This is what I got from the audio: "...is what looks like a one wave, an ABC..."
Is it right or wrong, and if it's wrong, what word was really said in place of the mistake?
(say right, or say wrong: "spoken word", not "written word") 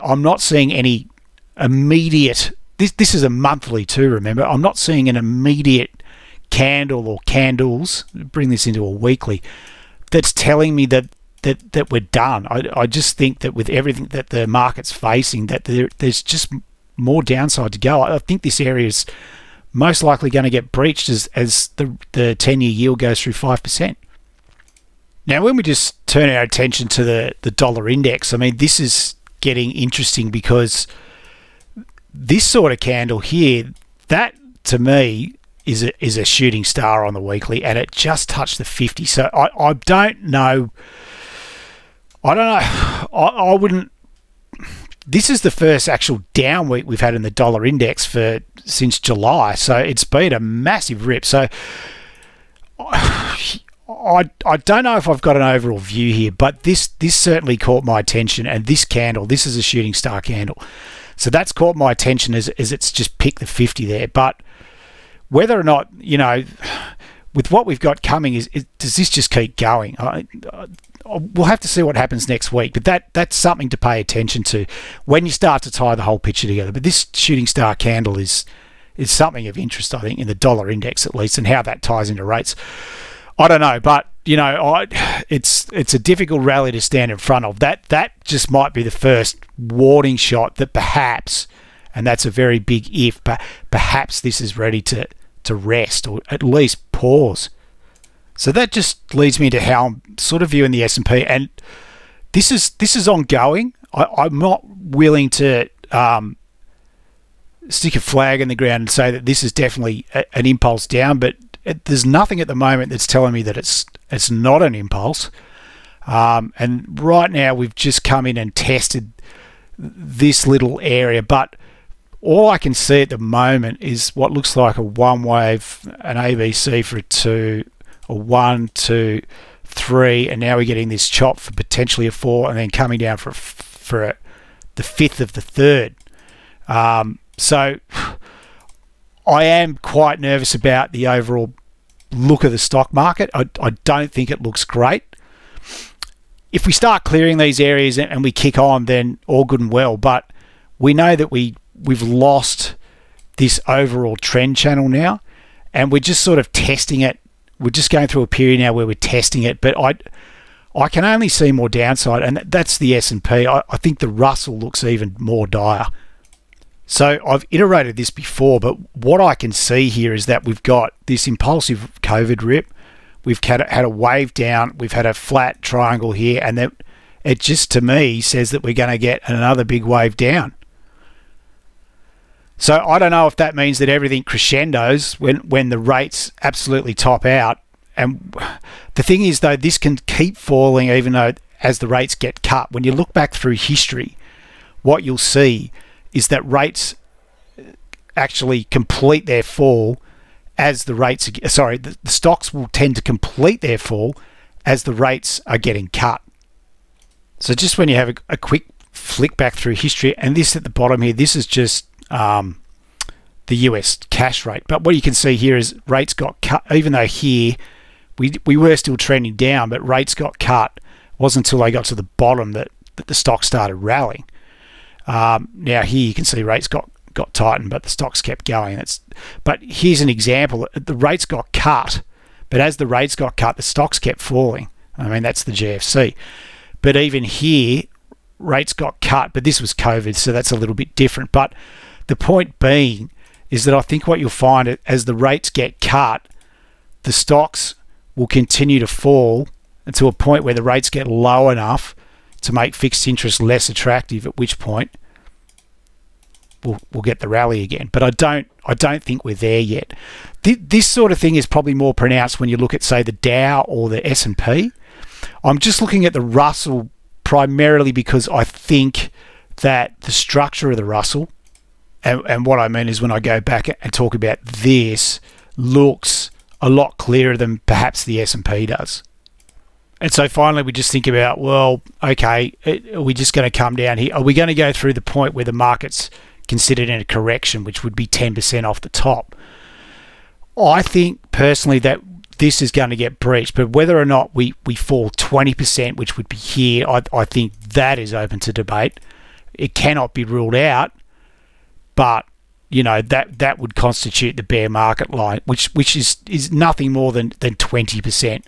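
right.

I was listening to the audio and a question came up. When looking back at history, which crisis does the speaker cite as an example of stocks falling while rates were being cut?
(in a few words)
The GFC.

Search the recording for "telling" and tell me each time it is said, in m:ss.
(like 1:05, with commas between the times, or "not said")
0:10, 1:53.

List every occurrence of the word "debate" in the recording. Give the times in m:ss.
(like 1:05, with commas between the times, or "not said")
4:58.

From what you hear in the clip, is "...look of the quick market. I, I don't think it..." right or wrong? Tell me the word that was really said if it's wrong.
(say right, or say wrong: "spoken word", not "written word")
wrong: "stock", not "quick".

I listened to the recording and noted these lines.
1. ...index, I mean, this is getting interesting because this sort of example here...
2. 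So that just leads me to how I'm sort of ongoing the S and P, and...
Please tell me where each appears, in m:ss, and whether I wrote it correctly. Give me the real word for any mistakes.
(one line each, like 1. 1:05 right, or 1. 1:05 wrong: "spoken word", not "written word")
1. 0:27 wrong: "candle", not "example"
2. 1:38 wrong: "viewing", not "ongoing".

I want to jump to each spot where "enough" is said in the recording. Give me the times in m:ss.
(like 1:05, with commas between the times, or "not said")
4:11.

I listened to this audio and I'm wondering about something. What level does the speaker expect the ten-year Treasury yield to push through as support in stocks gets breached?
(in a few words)
5%.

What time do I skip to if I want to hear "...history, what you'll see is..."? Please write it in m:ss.
3:13.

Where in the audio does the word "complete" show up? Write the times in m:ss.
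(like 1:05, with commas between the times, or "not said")
3:18, 3:23.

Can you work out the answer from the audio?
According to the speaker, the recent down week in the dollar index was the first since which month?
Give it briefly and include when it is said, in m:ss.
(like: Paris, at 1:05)
July, at 0:48.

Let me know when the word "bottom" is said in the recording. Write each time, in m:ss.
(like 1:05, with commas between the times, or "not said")
3:30, 3:42.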